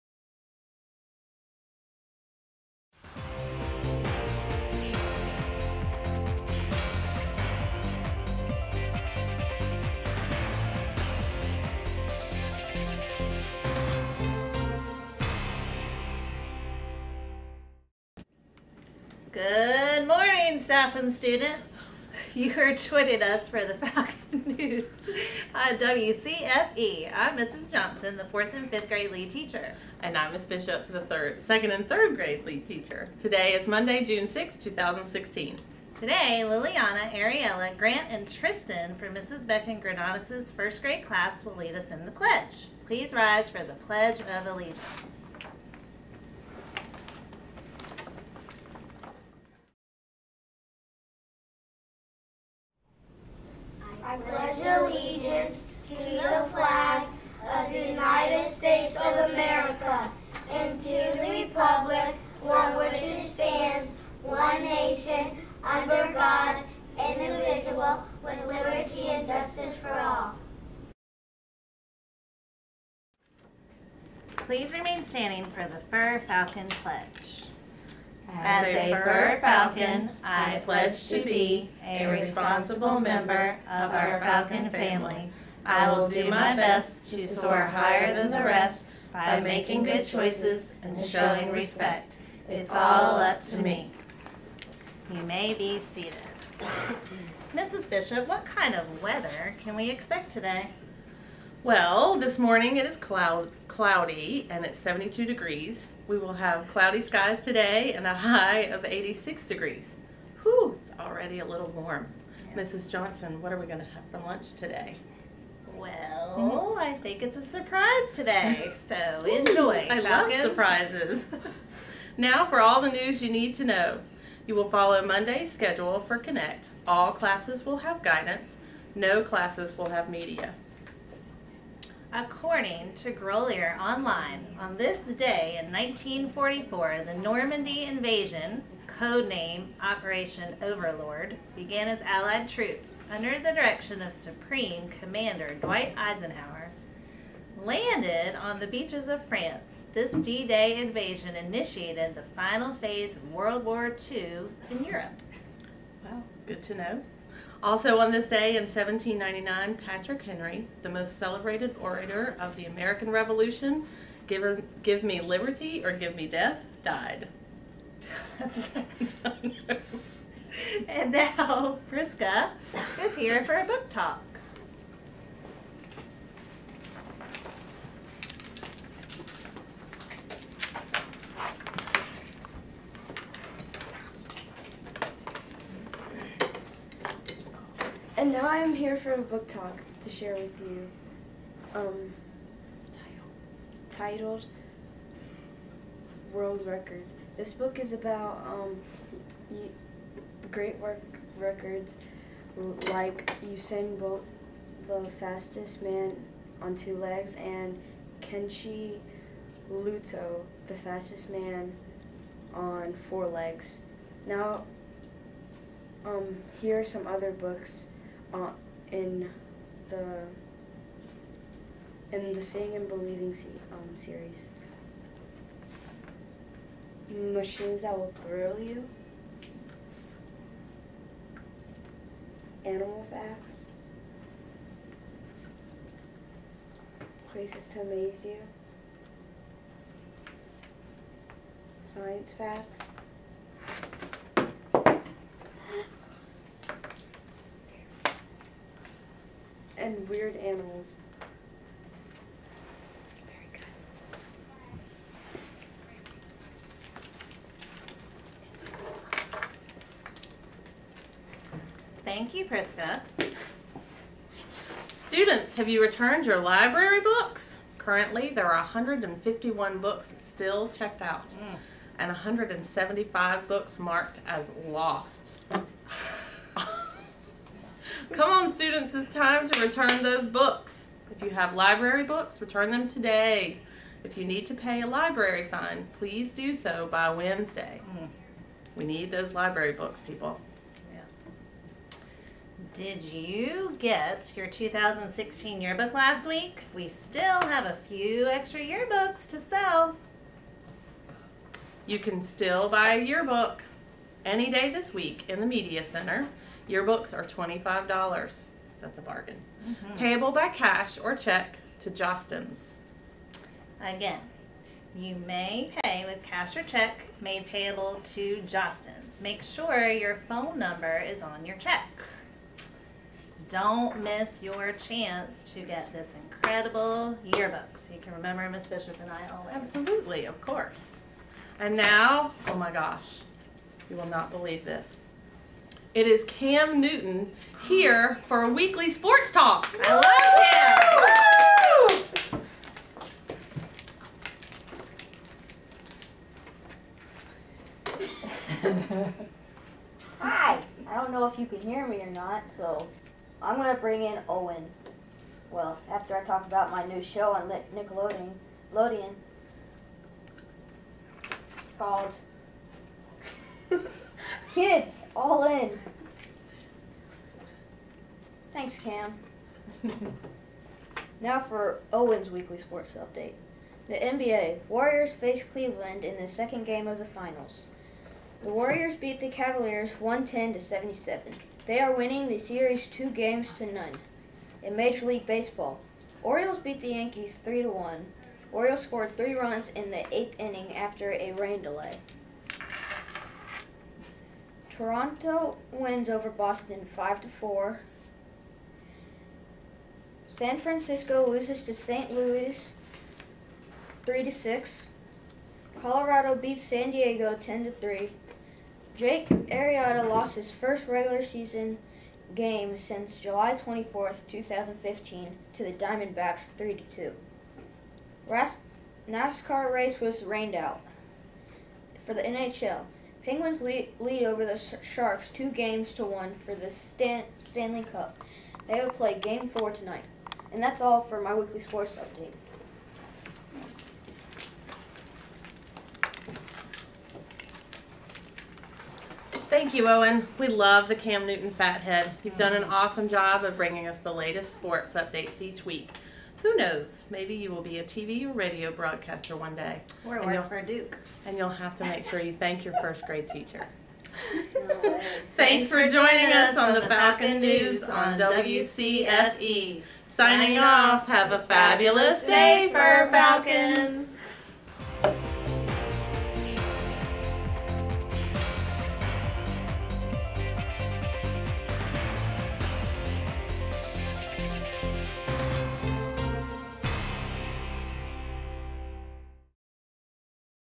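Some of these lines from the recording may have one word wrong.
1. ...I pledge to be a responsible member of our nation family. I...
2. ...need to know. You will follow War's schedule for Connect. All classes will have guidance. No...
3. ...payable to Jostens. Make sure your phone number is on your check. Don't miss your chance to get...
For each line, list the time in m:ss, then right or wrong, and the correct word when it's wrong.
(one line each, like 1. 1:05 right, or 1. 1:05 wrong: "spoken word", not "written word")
1. 1:20 wrong: "falcon", not "nation"
2. 2:03 wrong: "Monday", not "War"
3. 5:17 right.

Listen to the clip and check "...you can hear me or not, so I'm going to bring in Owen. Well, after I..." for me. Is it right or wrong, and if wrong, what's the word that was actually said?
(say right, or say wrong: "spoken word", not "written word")
right.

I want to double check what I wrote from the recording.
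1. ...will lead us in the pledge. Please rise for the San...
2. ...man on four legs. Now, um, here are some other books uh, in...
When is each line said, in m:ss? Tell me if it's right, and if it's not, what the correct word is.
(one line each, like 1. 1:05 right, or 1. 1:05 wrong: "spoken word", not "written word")
1. 0:41 wrong: "Pledge", not "San"
2. 3:31 right.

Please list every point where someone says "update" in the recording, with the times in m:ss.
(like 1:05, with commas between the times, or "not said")
6:12, 7:11, 7:24.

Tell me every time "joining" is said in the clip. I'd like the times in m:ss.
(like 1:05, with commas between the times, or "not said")
0:22, 7:35.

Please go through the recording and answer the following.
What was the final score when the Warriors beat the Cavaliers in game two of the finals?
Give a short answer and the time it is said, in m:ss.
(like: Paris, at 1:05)
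110 to 77, at 6:20.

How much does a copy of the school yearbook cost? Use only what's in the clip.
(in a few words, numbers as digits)
$25.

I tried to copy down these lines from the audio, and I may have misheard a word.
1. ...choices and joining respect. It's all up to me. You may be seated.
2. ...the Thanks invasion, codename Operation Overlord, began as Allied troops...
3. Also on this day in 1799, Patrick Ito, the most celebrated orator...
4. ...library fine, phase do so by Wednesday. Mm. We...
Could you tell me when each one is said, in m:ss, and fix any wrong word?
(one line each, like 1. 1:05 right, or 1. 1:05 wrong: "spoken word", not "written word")
1. 1:30 wrong: "showing", not "joining"
2. 2:17 wrong: "Normandy", not "Thanks"
3. 2:37 wrong: "Henry", not "Ito"
4. 4:44 wrong: "please", not "phase".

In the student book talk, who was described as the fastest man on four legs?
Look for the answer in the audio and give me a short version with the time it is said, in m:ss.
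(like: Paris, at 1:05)
Kenichi Ito, at 3:28.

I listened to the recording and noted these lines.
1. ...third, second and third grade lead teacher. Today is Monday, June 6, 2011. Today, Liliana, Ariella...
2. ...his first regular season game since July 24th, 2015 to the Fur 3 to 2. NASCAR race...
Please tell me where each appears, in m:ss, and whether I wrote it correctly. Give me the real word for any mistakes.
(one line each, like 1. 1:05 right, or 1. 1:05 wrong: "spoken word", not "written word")
1. 0:30 wrong: "2016", not "2011"
2. 6:50 wrong: "Diamondbacks", not "Fur".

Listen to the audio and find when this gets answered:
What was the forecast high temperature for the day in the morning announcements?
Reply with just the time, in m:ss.
1:48.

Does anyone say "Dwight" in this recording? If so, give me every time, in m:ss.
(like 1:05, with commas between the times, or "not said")
2:25.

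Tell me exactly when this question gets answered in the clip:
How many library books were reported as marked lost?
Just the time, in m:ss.
4:32.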